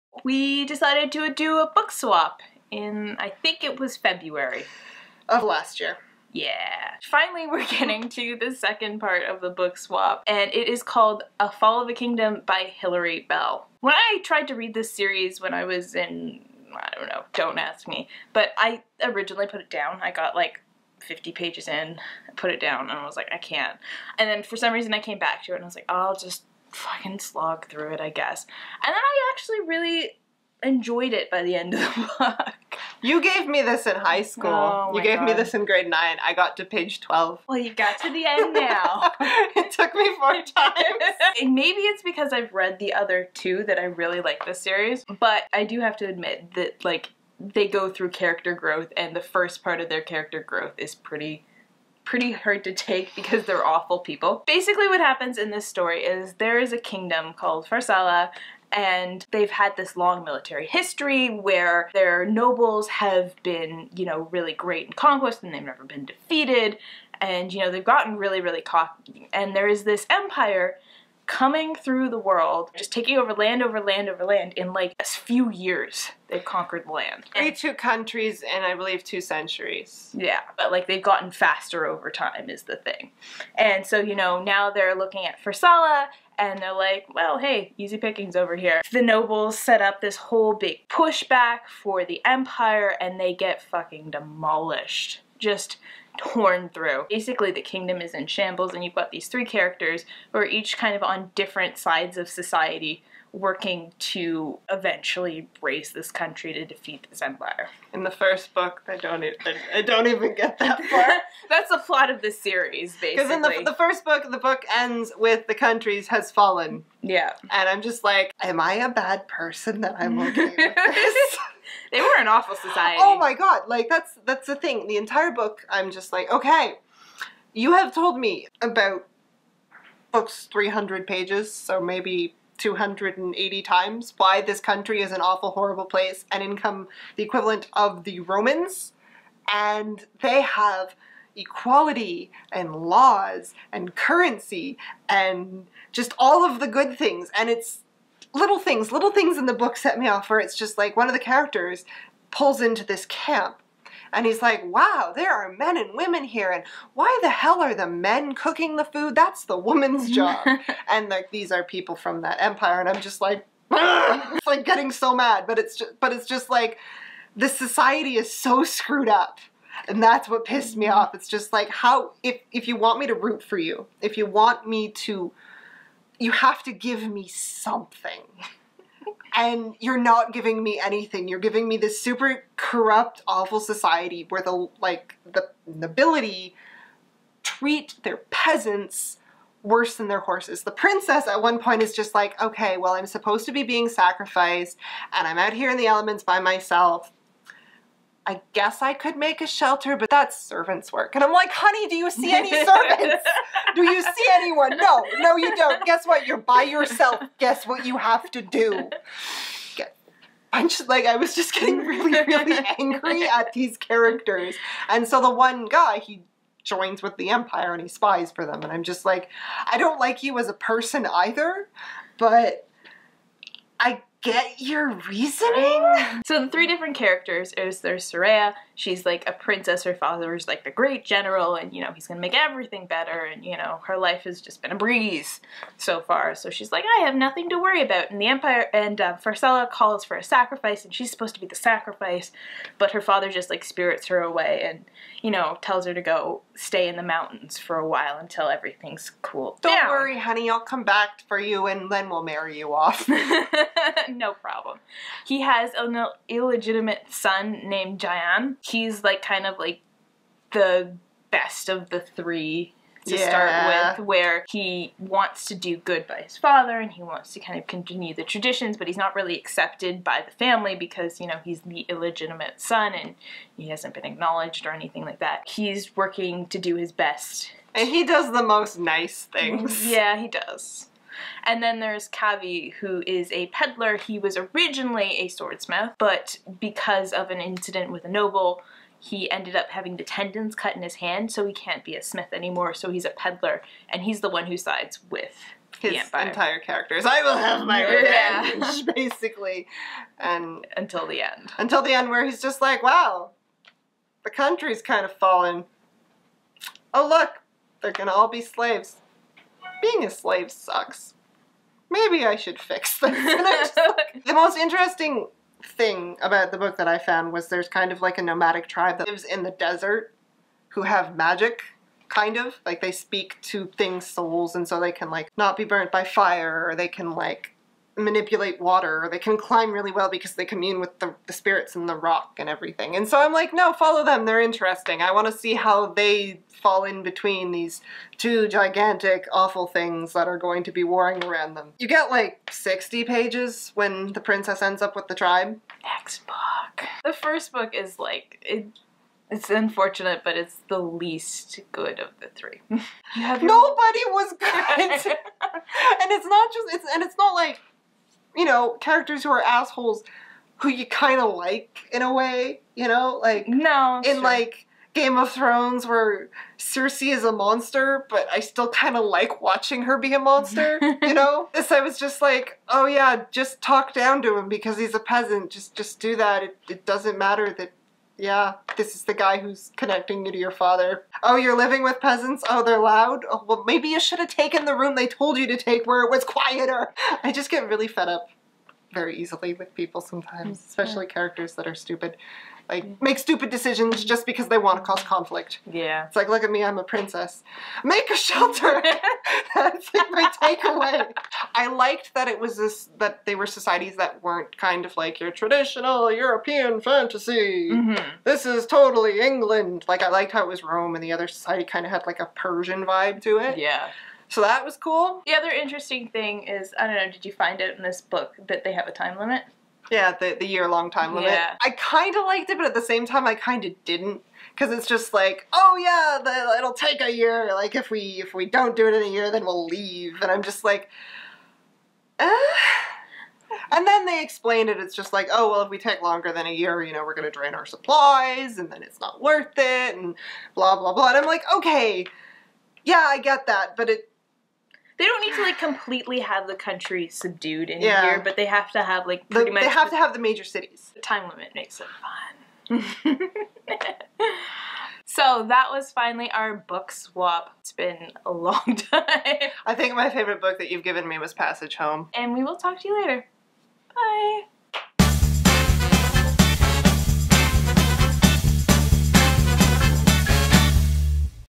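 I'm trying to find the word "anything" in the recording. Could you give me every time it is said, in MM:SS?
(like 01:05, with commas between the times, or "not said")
03:00, 04:34.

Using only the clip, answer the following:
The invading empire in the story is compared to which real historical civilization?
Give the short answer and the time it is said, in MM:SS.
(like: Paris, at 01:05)
The Romans, at 02:18.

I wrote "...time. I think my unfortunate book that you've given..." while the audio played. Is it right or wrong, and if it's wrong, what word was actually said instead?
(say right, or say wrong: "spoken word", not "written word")
wrong: "favorite", not "unfortunate".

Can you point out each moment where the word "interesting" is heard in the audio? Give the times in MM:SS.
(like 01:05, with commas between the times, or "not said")
05:14, 05:34, 06:55.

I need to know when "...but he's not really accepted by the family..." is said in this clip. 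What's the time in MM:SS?
04:28.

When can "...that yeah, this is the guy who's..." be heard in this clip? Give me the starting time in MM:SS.
06:17.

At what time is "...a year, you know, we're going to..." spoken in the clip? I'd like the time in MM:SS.
07:16.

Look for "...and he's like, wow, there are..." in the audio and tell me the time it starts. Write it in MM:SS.
02:34.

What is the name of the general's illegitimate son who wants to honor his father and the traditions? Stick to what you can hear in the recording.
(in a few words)
Jiaan.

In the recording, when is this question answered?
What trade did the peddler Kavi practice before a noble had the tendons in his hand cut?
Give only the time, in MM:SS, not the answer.
04:45.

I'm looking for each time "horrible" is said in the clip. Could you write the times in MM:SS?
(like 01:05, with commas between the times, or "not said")
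02:15.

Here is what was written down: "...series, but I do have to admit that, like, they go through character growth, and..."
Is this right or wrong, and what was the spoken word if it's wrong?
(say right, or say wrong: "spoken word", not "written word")
right.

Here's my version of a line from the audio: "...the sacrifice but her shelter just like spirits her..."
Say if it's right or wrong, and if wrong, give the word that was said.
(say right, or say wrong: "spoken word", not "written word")
wrong: "father", not "shelter".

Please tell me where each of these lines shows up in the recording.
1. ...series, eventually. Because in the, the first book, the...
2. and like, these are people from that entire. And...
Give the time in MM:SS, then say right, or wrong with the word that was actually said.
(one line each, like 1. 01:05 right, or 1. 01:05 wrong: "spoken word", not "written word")
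1. 01:52 wrong: "basically", not "eventually"
2. 02:40 wrong: "empire", not "entire".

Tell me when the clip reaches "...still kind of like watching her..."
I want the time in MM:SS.
06:08.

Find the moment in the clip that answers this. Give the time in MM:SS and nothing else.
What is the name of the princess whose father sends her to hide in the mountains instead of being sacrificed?
03:48.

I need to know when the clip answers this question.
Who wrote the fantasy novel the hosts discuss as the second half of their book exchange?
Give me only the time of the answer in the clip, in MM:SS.
00:12.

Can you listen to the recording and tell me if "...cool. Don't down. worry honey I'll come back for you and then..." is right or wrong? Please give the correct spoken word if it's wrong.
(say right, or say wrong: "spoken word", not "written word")
right.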